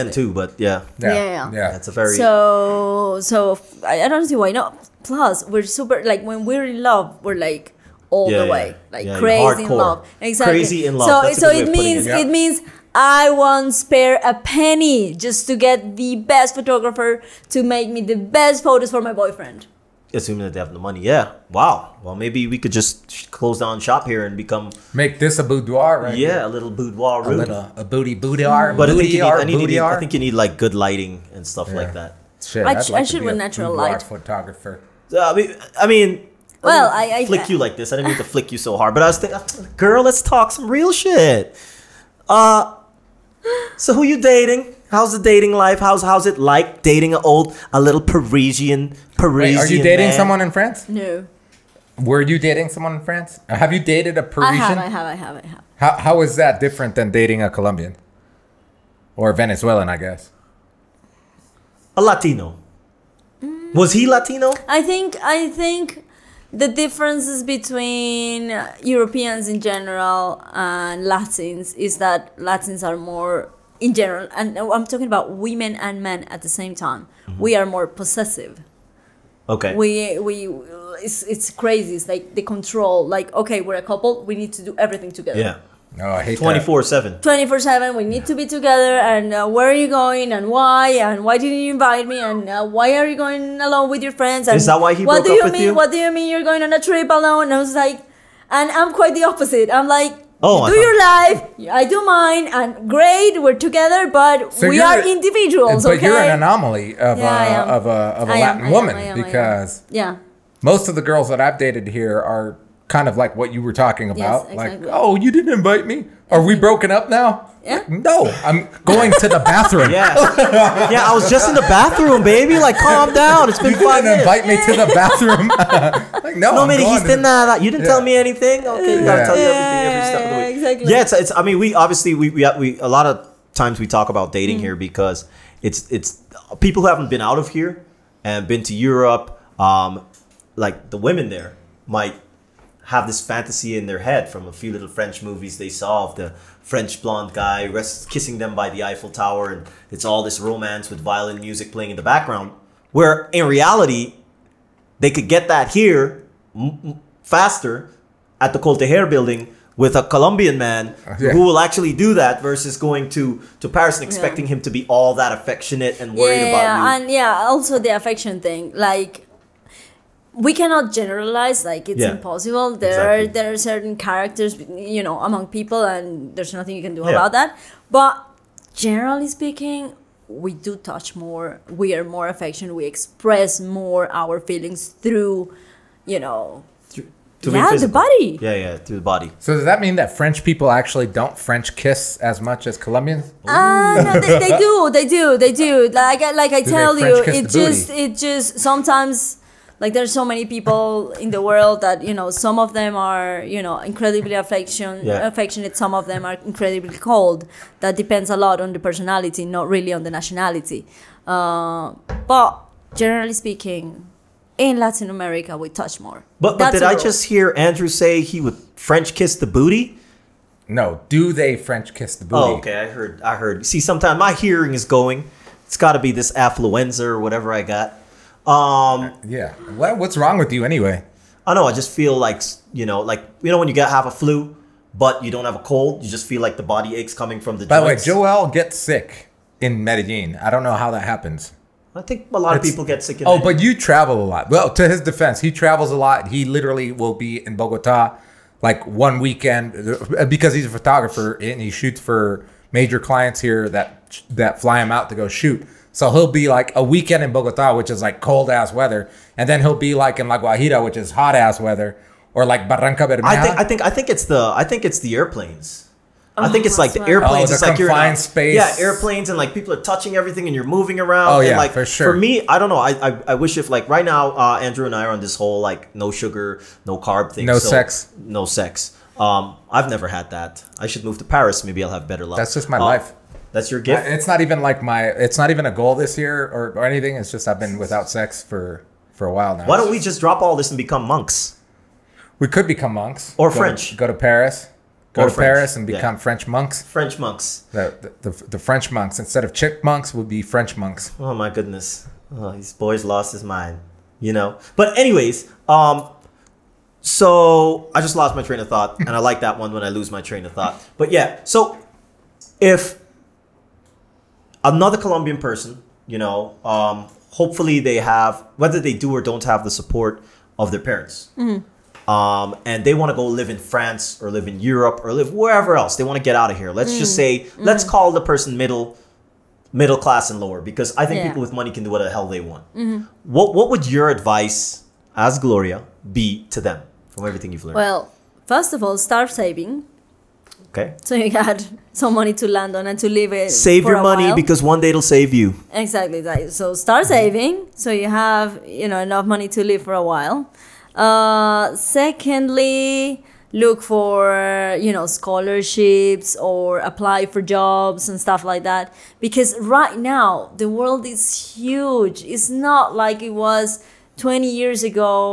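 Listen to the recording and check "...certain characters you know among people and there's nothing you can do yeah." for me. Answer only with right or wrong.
right.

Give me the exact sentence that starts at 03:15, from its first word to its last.
Like, like I do tell you, it just, booty?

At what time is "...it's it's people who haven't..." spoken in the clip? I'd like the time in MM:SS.
02:15.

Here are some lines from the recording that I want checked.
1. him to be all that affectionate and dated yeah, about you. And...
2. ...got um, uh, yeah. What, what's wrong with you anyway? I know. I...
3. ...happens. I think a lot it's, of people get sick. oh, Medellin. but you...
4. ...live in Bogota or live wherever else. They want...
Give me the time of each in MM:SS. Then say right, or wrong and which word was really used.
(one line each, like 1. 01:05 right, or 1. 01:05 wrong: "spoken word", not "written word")
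1. 02:44 wrong: "worried", not "dated"
2. 03:47 right
3. 04:01 right
4. 05:24 wrong: "Europe", not "Bogota".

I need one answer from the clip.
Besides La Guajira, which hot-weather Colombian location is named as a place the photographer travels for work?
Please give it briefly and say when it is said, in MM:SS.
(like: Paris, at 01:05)
Barrancabermeja, at 04:22.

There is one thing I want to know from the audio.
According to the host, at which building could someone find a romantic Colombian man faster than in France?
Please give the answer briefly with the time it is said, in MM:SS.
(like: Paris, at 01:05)
de Hair building, at 02:38.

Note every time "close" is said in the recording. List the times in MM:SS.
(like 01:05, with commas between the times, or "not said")
00:23.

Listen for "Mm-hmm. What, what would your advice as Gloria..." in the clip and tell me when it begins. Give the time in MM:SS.
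05:32.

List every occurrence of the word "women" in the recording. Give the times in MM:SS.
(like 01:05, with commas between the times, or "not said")
01:15, 02:20.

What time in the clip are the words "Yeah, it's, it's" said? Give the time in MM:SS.
02:10.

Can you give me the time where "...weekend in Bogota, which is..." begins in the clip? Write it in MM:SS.
04:16.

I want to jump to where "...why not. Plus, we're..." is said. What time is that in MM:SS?
00:04.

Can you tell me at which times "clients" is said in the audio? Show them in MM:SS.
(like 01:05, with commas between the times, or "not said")
04:12.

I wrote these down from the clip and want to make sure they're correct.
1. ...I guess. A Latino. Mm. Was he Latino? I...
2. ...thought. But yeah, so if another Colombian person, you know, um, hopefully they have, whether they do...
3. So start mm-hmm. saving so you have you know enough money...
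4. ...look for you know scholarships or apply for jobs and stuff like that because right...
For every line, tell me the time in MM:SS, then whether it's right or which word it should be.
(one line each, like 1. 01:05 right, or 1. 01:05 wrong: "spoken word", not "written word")
1. 00:59 right
2. 05:10 right
3. 05:46 right
4. 05:53 right.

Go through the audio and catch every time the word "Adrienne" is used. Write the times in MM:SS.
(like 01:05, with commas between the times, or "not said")
not said.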